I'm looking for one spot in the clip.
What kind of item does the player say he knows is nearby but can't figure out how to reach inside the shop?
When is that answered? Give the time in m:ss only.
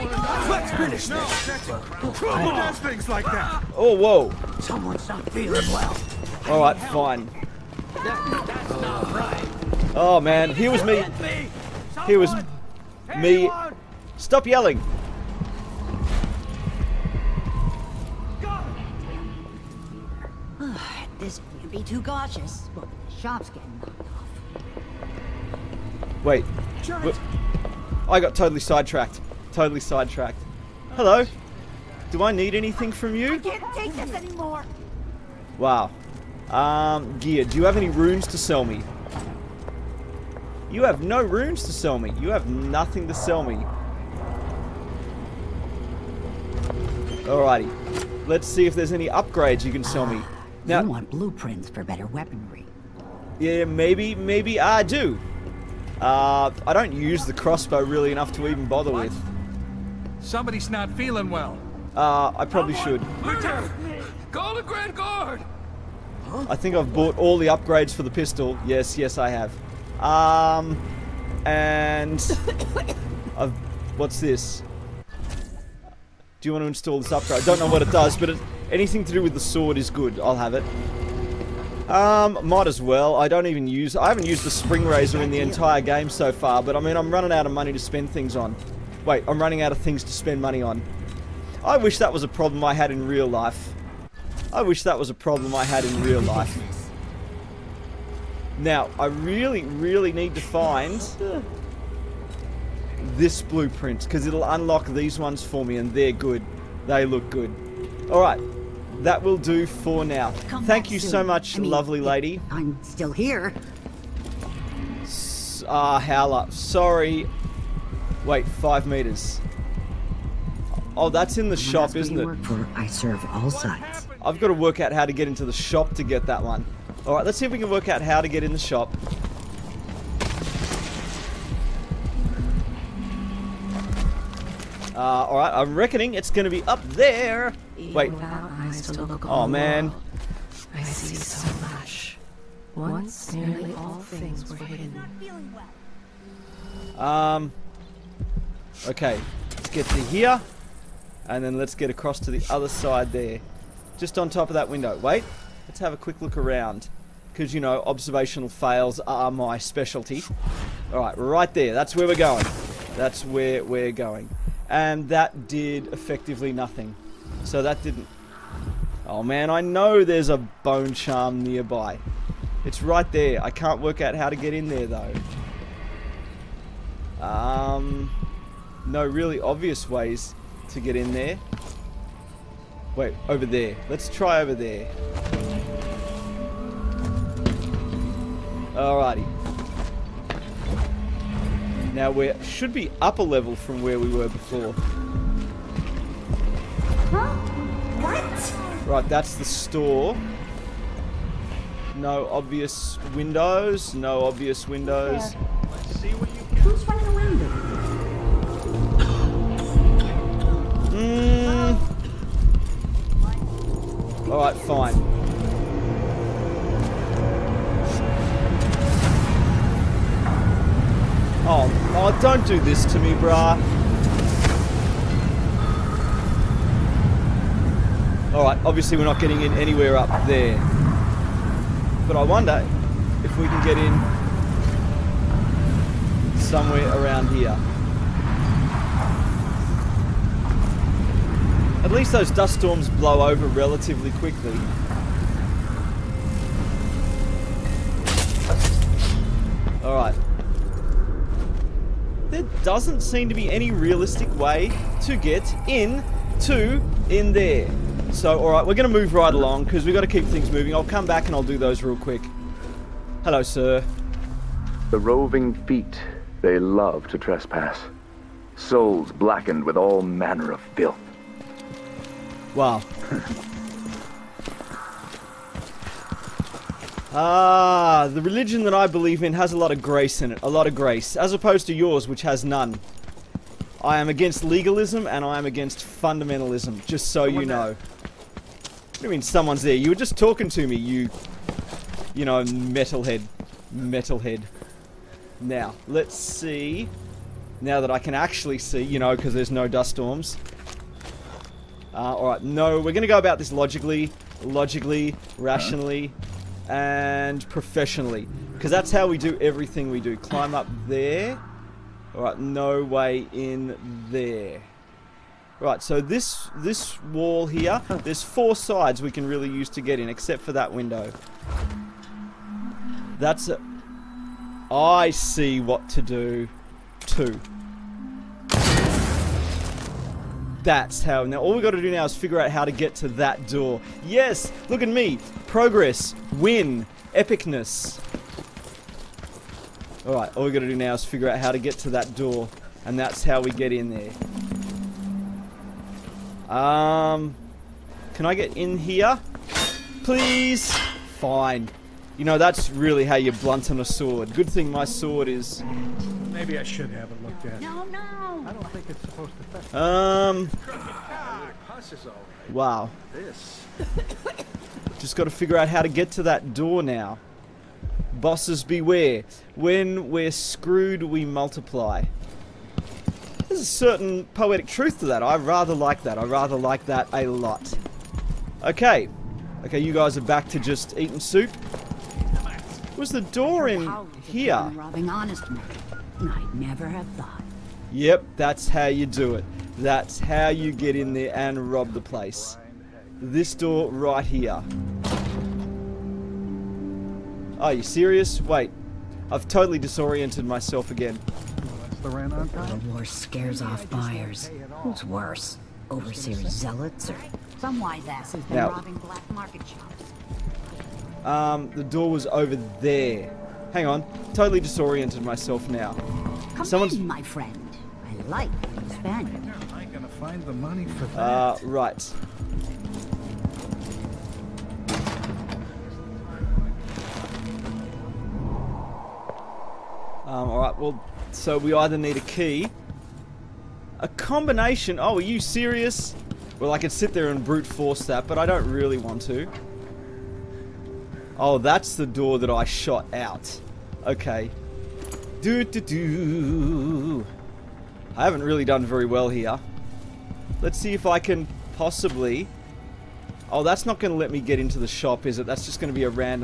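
2:50.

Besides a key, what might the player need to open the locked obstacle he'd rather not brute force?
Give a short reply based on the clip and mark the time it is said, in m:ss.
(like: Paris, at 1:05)
combination, at 7:14.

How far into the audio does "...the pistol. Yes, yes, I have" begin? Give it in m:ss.
1:08.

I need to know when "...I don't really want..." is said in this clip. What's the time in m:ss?
7:18.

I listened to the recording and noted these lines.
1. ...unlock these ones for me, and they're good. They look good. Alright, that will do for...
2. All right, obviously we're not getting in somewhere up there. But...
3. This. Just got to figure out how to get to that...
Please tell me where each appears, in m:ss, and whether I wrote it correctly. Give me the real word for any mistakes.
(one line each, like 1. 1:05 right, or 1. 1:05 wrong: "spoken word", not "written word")
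1. 1:44 right
2. 3:48 wrong: "anywhere", not "somewhere"
3. 6:03 right.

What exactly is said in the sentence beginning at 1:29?
Wait, I'm running out of things to spend money on.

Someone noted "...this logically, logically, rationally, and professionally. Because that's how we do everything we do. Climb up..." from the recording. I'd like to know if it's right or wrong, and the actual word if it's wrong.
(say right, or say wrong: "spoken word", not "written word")
right.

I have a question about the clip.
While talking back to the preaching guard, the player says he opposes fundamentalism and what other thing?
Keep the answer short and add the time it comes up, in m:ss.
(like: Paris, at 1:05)
legalism, at 4:44.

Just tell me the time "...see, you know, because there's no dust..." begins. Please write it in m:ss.
4:58.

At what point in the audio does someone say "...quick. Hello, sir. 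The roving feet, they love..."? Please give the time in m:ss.
4:21.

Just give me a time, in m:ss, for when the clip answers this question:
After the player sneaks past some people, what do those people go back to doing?
6:20.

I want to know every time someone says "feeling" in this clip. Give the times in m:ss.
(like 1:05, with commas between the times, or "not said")
0:05, 1:00.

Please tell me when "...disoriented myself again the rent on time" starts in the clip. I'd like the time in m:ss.
6:39.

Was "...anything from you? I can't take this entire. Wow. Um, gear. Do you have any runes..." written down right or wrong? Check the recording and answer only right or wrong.
wrong.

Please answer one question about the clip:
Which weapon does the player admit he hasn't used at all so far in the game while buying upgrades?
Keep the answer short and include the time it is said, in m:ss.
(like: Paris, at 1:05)
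spring razor, at 1:24.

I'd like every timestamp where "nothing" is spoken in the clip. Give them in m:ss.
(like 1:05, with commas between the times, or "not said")
0:42, 2:46.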